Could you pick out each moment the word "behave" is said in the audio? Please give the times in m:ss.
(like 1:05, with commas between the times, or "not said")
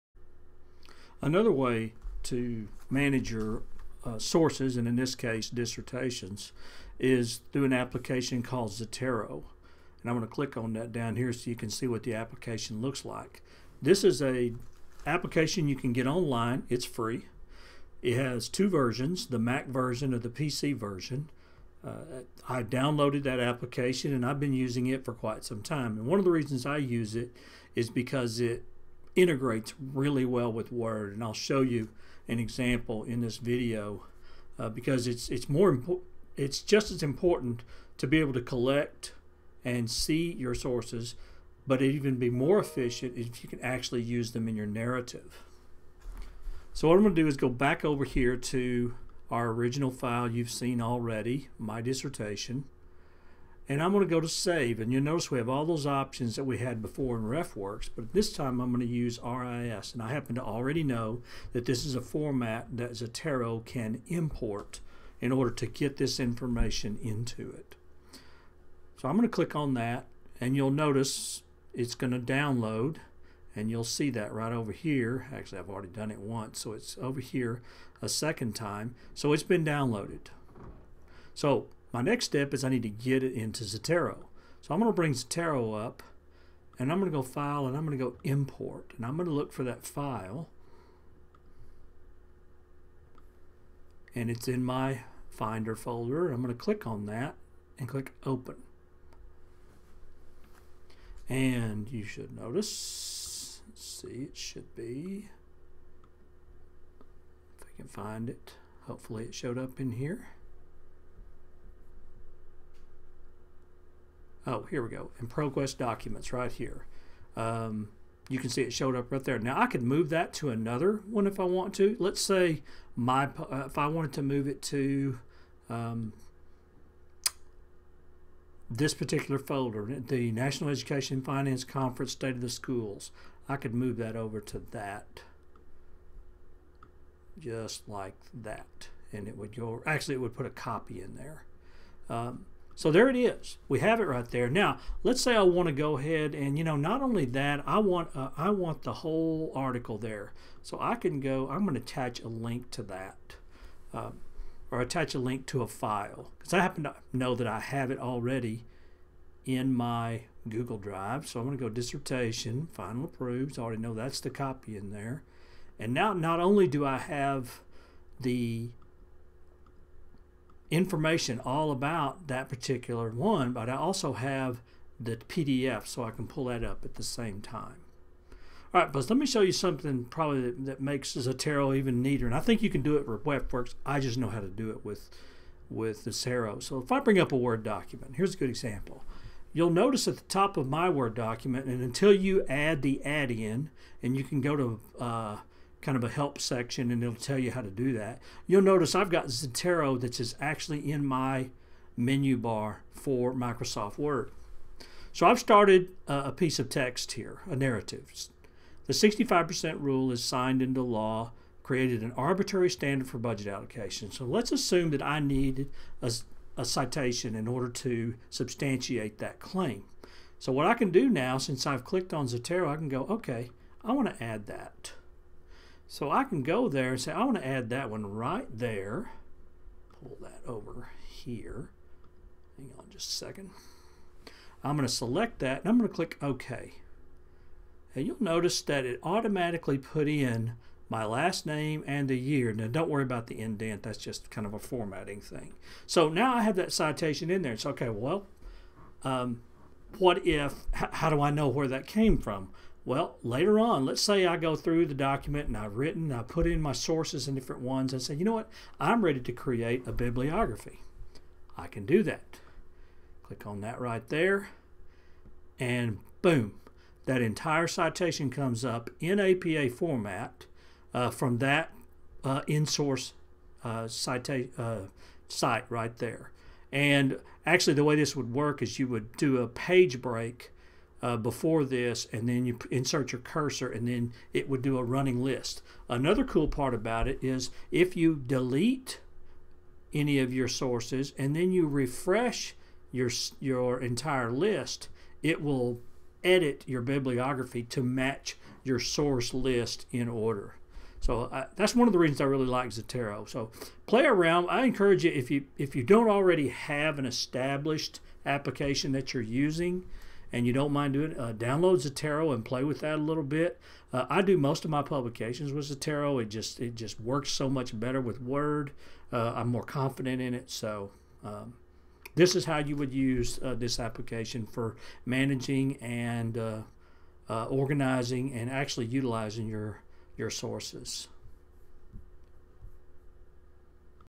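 not said.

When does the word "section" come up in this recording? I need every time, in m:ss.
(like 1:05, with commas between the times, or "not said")
3:16.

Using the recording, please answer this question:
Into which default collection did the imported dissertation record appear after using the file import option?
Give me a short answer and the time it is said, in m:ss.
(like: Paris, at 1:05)
ProQuest Documents, at 1:55.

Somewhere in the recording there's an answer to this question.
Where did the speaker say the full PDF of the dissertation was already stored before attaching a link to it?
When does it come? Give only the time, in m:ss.
2:40.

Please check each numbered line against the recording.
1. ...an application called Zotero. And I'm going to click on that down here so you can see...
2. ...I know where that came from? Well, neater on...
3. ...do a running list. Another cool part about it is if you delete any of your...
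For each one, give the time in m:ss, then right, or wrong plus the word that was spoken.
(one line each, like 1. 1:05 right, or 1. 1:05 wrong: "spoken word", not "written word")
1. 0:07 right
2. 4:11 wrong: "later", not "neater"
3. 4:44 right.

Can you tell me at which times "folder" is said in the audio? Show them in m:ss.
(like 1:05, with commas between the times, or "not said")
1:35, 2:09.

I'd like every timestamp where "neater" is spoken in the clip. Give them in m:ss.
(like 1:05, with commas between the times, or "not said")
3:02.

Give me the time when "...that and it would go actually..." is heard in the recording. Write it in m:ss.
2:18.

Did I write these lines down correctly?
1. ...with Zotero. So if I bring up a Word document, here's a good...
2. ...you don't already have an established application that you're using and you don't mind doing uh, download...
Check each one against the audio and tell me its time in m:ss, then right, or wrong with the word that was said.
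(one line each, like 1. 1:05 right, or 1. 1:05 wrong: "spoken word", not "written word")
1. 3:05 right
2. 5:05 right.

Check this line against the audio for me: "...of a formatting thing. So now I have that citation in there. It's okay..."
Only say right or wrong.
right.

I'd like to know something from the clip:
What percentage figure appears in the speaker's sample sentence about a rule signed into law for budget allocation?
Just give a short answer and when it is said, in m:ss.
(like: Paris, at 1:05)
65%, at 3:28.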